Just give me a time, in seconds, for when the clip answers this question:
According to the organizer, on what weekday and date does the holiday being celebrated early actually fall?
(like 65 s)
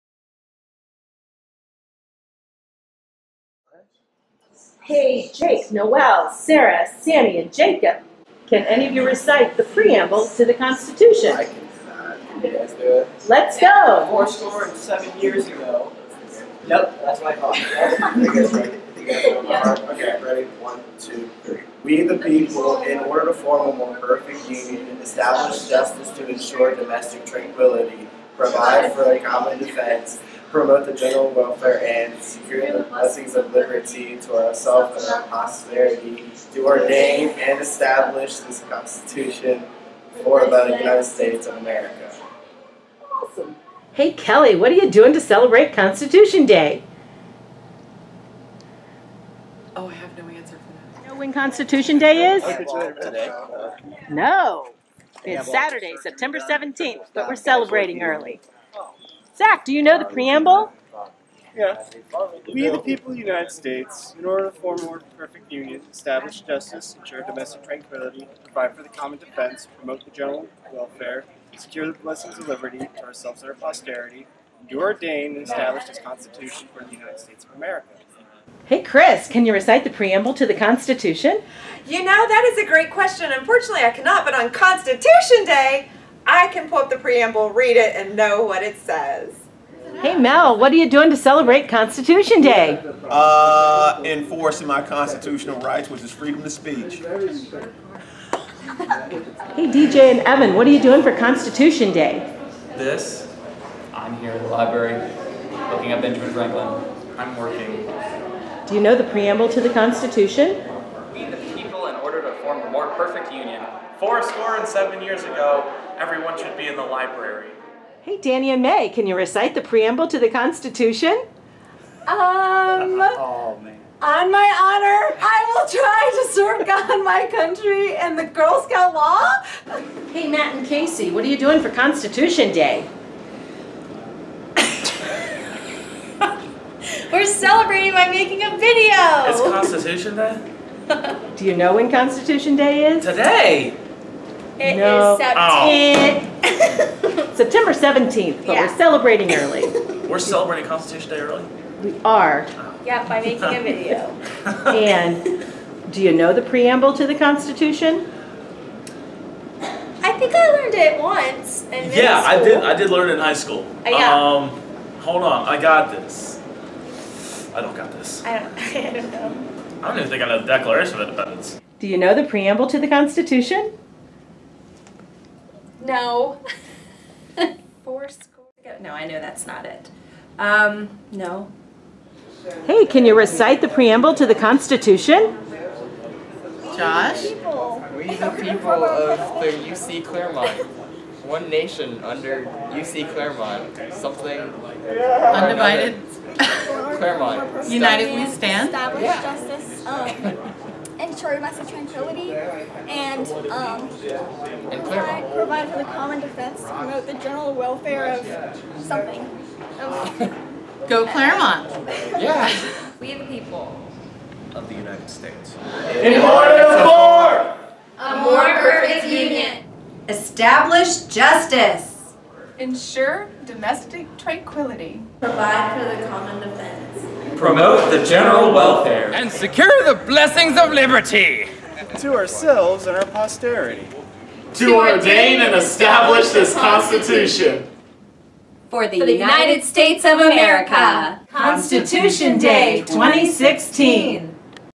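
55 s.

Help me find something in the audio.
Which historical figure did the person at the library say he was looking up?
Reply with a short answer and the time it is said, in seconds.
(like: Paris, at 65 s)
Benjamin Franklin, at 106 s.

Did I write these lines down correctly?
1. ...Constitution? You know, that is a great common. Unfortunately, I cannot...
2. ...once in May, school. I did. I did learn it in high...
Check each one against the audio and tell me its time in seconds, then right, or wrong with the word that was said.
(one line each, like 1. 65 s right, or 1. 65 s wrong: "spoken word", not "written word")
1. 80 s wrong: "question", not "common"
2. 161 s wrong: "Yeah", not "May".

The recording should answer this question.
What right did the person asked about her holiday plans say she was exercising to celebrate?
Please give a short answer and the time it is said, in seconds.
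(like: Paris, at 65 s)
Freedom of speech, at 96 s.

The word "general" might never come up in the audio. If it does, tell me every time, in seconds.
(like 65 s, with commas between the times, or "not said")
30 s, 70 s, 207 s, 228 s.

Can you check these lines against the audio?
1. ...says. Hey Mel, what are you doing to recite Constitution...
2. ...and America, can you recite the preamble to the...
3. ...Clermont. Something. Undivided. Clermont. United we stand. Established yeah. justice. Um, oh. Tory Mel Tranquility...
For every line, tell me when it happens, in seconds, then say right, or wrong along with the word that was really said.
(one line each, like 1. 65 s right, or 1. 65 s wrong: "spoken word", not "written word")
1. 88 s wrong: "celebrate", not "recite"
2. 118 s wrong: "May", not "America"
3. 193 s wrong: "Master", not "Mel".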